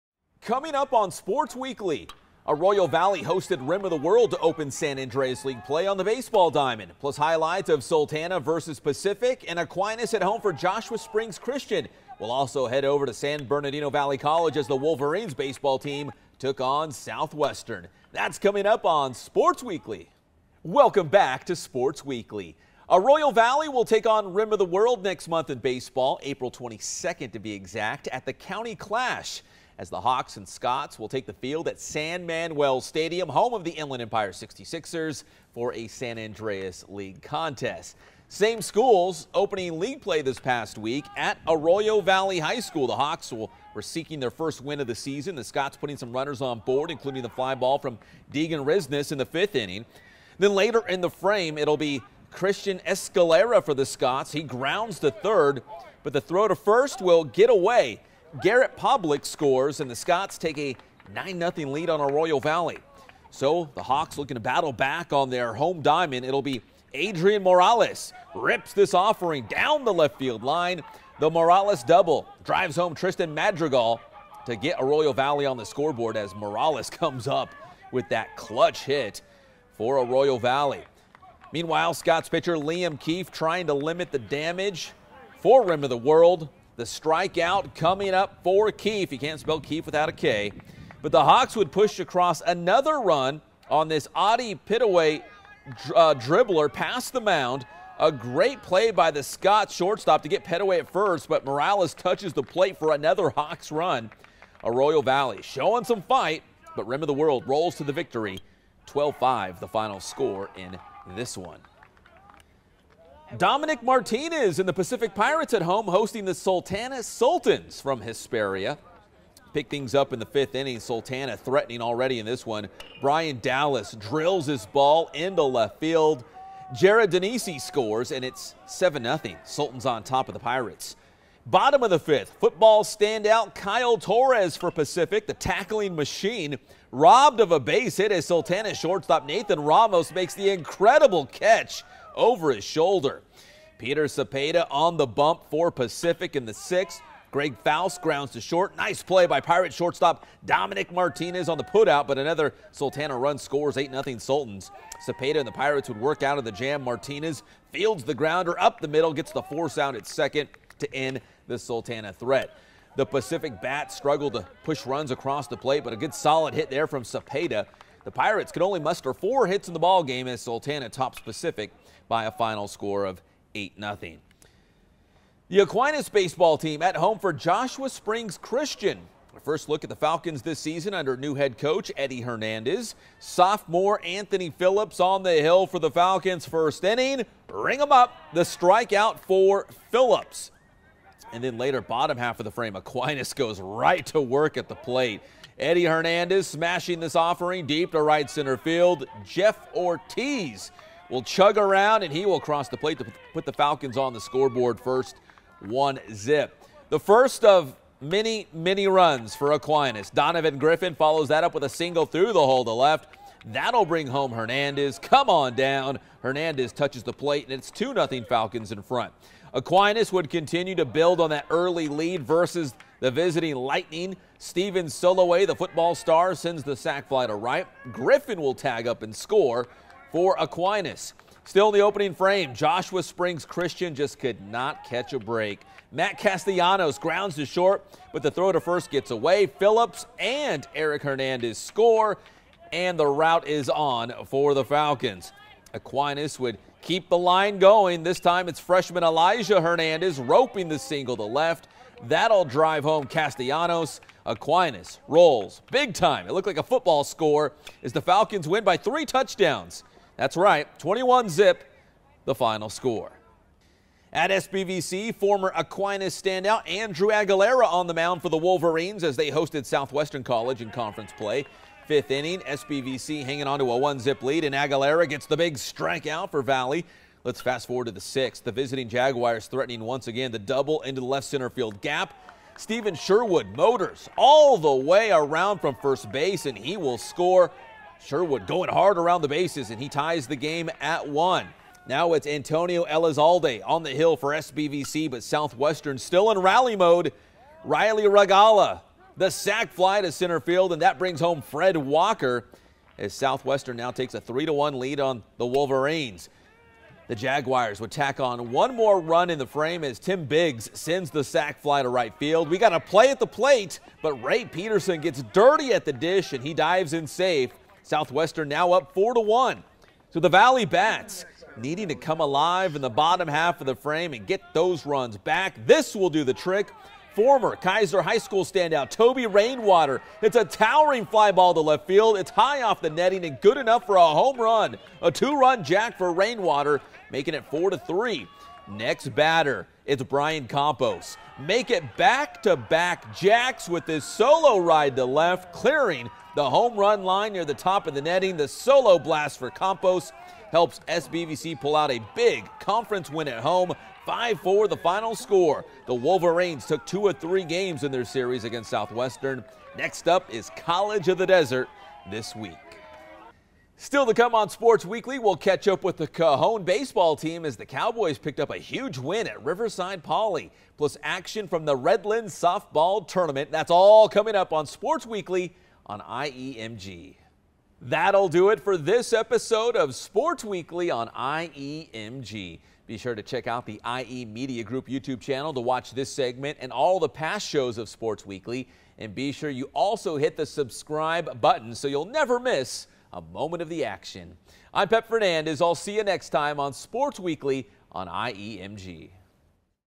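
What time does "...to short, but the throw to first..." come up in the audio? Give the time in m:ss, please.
3:57.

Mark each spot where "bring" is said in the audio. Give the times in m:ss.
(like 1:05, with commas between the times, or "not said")
3:33, 5:00.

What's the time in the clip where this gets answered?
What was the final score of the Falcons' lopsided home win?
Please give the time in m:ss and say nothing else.
4:20.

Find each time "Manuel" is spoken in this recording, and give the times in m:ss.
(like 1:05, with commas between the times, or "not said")
0:32.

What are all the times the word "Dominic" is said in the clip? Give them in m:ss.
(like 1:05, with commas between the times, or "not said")
1:53, 2:30.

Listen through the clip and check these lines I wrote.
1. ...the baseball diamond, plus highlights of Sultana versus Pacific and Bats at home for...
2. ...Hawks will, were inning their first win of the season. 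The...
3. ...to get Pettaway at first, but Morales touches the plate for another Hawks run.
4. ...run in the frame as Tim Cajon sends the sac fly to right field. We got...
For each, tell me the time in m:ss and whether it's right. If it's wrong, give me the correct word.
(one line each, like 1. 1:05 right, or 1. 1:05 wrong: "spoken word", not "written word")
1. 0:05 wrong: "Aquinas", not "Bats"
2. 0:42 wrong: "seeking", not "inning"
3. 1:40 right
4. 5:09 wrong: "Biggs", not "Cajon".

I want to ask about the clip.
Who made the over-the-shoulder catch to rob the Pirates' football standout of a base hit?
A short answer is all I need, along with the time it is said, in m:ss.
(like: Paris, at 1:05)
Nathan Ramos, at 2:19.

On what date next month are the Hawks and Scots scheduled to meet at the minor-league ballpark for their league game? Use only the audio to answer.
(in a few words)
April 22.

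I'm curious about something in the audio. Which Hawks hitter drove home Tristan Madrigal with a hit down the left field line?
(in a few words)
Adrian Morales.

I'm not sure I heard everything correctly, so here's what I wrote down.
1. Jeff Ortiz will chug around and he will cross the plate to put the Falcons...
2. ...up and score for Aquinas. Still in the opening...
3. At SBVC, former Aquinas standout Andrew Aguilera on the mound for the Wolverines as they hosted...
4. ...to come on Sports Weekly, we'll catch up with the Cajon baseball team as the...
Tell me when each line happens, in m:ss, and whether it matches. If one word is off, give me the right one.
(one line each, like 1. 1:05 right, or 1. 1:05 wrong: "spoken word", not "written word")
1. 3:19 right
2. 3:48 right
3. 4:24 right
4. 6:04 right.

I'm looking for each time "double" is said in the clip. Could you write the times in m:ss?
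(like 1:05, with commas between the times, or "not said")
1:11, 4:40.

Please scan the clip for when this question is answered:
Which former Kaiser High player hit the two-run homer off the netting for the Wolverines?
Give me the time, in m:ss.
5:28.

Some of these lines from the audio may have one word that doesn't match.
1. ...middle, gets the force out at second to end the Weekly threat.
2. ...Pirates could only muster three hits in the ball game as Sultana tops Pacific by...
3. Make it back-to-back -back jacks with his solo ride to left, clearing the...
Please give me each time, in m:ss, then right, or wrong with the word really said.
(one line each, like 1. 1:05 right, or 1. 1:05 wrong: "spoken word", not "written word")
1. 2:38 wrong: "Sultana", not "Weekly"
2. 2:48 wrong: "four", not "three"
3. 5:41 right.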